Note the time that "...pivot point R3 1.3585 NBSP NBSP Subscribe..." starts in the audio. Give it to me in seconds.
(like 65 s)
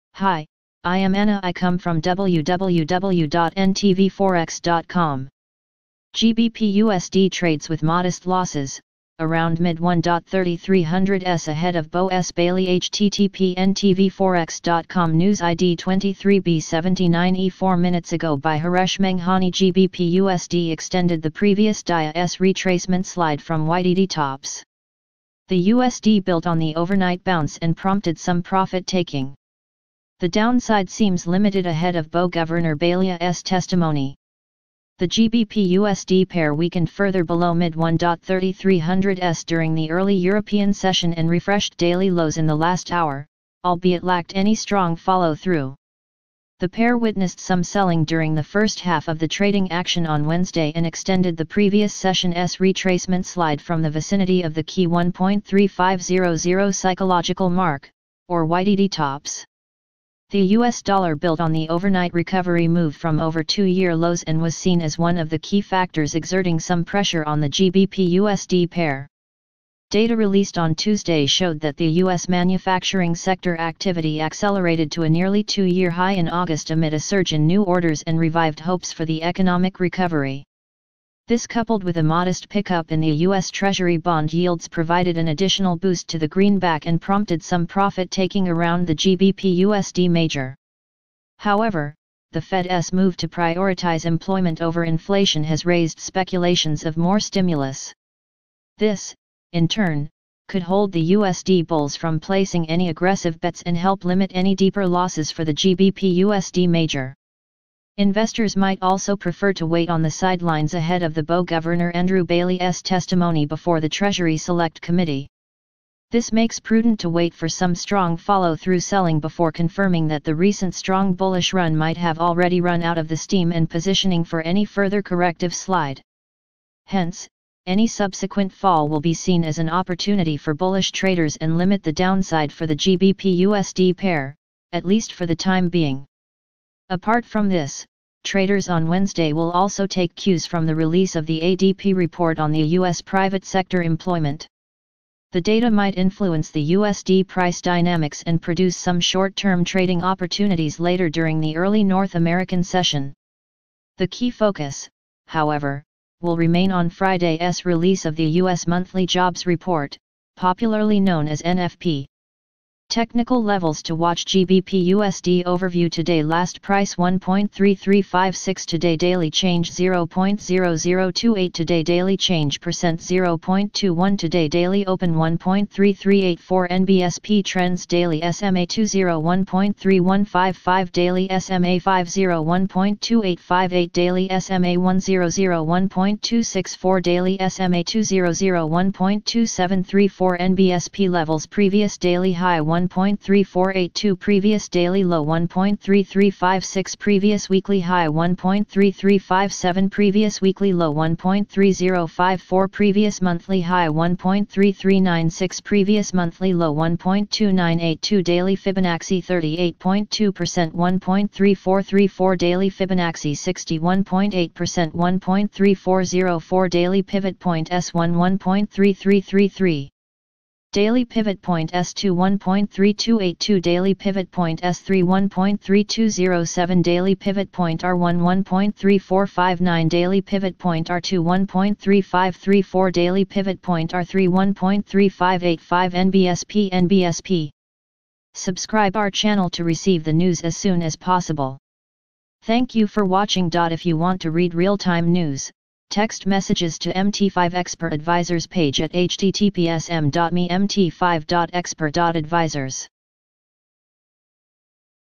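233 s.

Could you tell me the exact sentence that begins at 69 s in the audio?
Data released on Tuesday showed that the U.S.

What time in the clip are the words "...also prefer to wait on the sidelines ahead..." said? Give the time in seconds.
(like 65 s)
108 s.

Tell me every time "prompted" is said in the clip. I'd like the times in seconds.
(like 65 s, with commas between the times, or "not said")
27 s, 86 s.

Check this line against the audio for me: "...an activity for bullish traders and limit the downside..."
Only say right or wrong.
wrong.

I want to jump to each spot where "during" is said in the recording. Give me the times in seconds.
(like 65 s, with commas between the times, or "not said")
39 s, 48 s, 151 s.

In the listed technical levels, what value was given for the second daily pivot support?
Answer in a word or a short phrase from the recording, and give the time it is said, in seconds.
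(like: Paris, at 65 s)
1.3282, at 222 s.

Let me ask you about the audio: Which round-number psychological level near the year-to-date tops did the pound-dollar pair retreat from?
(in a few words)
1.3500.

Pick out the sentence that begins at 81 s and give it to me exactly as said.
This coupled with a modest pickup in the U.S.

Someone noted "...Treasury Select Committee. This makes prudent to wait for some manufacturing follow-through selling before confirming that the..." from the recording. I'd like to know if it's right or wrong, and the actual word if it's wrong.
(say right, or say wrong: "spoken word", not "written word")
wrong: "strong", not "manufacturing".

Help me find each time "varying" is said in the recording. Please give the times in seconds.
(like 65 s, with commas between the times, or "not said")
not said.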